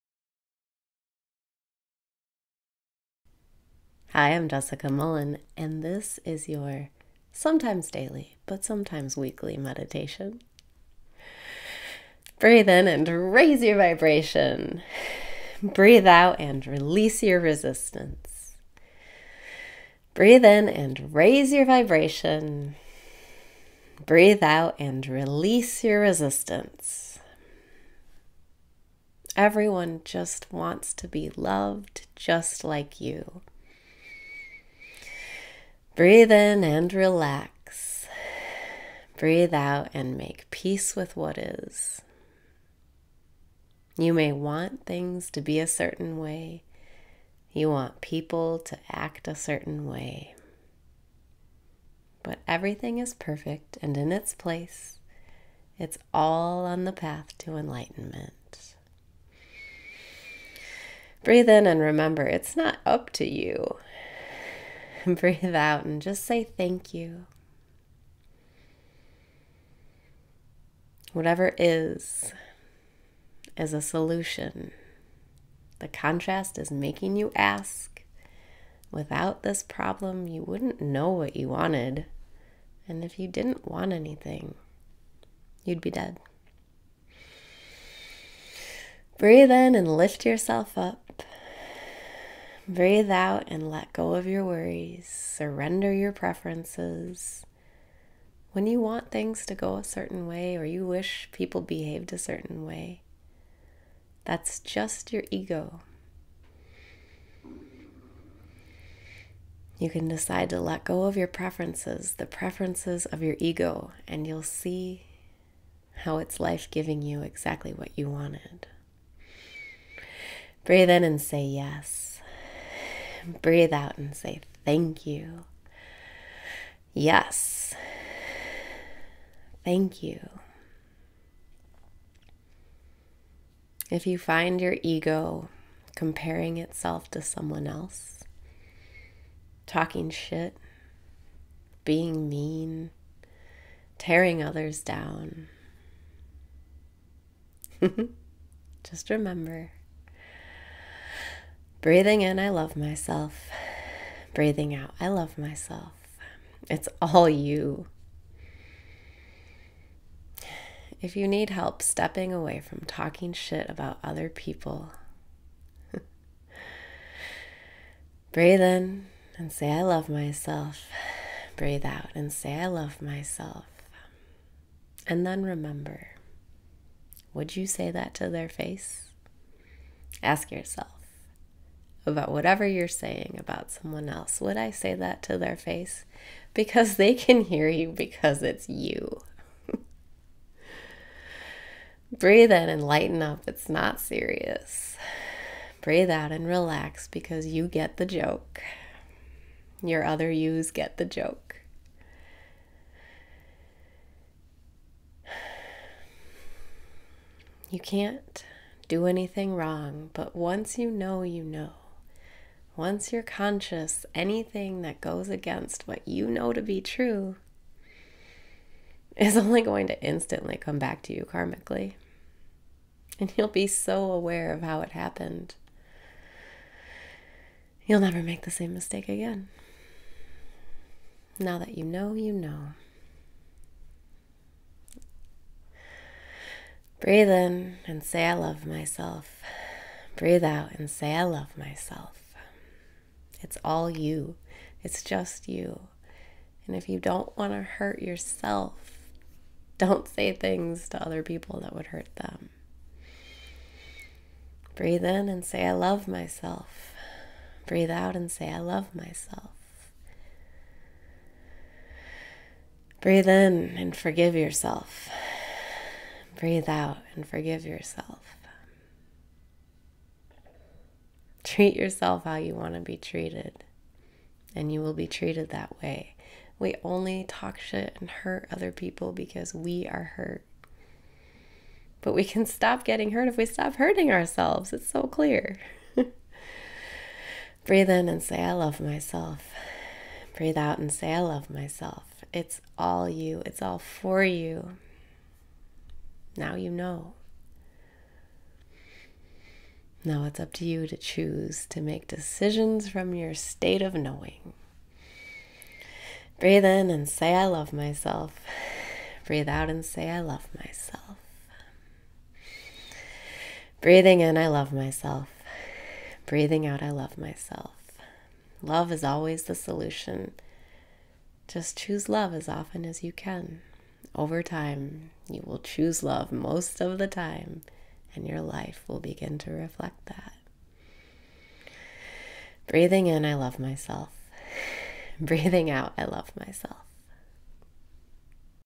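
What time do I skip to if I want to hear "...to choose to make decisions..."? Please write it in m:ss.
5:00.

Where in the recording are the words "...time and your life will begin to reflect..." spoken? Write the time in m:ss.
5:27.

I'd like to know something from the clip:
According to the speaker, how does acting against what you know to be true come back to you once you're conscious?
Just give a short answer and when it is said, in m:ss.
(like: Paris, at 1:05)
karmically, at 3:41.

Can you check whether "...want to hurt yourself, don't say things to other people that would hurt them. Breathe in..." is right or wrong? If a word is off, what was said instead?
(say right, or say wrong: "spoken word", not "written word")
right.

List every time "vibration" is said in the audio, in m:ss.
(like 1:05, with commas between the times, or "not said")
0:13, 0:21.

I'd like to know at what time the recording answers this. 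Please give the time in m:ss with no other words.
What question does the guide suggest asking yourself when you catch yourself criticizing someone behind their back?
3:04.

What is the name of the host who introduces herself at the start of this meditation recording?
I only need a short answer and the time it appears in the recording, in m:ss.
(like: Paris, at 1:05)
Jessica Mullen, at 0:04.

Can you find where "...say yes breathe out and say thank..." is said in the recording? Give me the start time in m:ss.
2:01.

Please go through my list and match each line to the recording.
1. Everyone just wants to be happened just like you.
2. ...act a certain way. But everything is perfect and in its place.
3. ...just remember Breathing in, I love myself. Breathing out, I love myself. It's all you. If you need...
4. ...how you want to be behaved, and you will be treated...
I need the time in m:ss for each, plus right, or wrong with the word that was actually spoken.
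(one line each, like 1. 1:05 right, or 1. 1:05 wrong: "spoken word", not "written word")
1. 0:29 wrong: "loved", not "happened"
2. 0:48 right
3. 2:28 right
4. 4:32 wrong: "treated", not "behaved".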